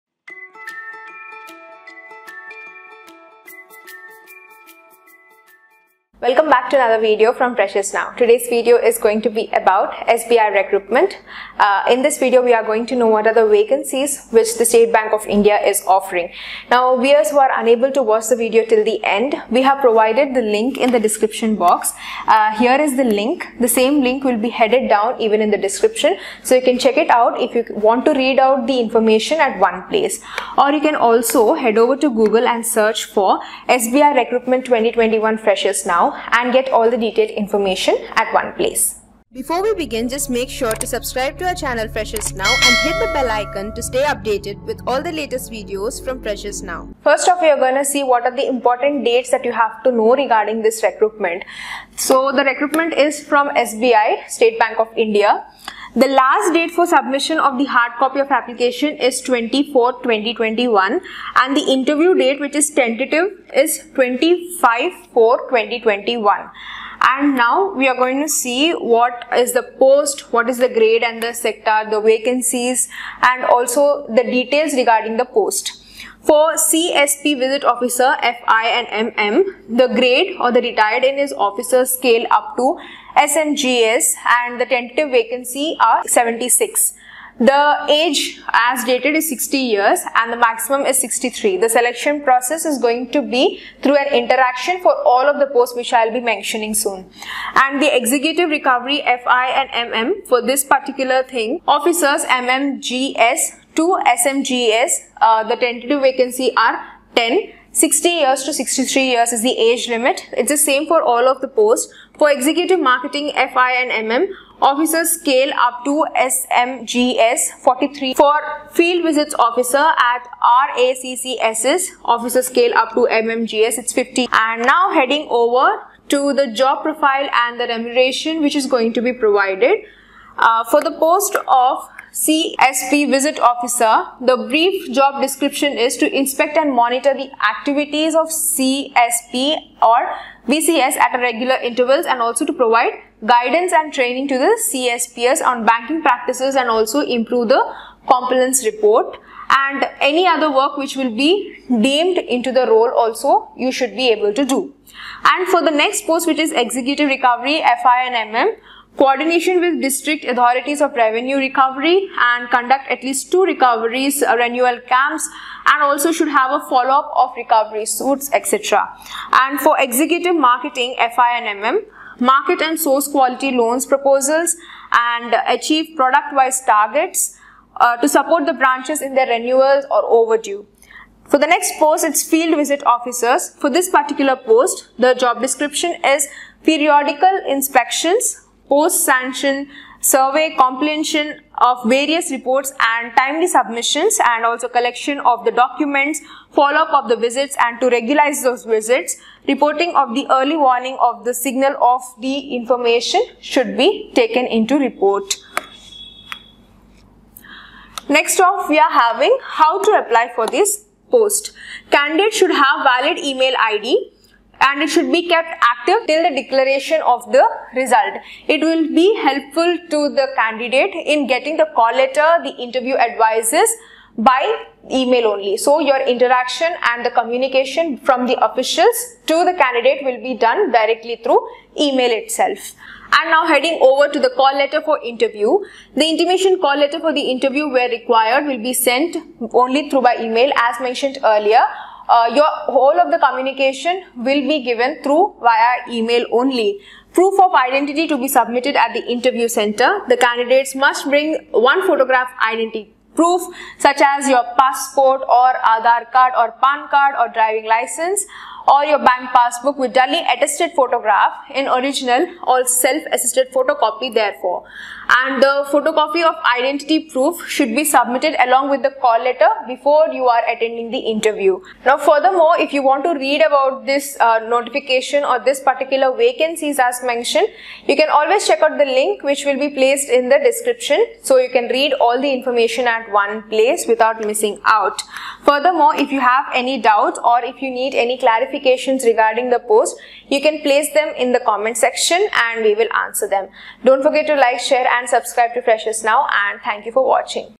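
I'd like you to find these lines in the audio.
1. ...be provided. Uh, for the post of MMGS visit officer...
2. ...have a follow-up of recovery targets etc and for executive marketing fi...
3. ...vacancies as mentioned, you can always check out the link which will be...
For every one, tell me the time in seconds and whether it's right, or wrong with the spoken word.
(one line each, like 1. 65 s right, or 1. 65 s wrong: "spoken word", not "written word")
1. 129 s wrong: "CSP", not "MMGS"
2. 166 s wrong: "suits", not "targets"
3. 276 s right.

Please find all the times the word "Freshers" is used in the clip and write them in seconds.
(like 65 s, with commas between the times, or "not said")
7 s, 35 s, 41 s, 46 s, 295 s.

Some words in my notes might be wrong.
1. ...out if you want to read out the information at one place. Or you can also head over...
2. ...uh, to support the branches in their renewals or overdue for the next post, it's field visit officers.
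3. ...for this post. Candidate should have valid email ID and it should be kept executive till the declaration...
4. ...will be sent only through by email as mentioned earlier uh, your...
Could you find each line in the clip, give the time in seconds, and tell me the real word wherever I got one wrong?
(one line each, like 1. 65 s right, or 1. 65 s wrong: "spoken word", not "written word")
1. 27 s right
2. 177 s right
3. 210 s wrong: "active", not "executive"
4. 238 s right.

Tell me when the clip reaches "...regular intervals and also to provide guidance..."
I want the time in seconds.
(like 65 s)
141 s.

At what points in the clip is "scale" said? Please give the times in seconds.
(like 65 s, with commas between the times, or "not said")
81 s, 115 s, 122 s.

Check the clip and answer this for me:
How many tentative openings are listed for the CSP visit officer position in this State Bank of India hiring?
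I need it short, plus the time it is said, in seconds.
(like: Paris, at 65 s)
76, at 86 s.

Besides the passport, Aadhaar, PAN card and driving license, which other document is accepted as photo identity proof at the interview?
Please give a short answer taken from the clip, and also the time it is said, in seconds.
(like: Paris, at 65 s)
bank passbook, at 258 s.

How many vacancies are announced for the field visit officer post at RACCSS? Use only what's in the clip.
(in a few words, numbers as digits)
50.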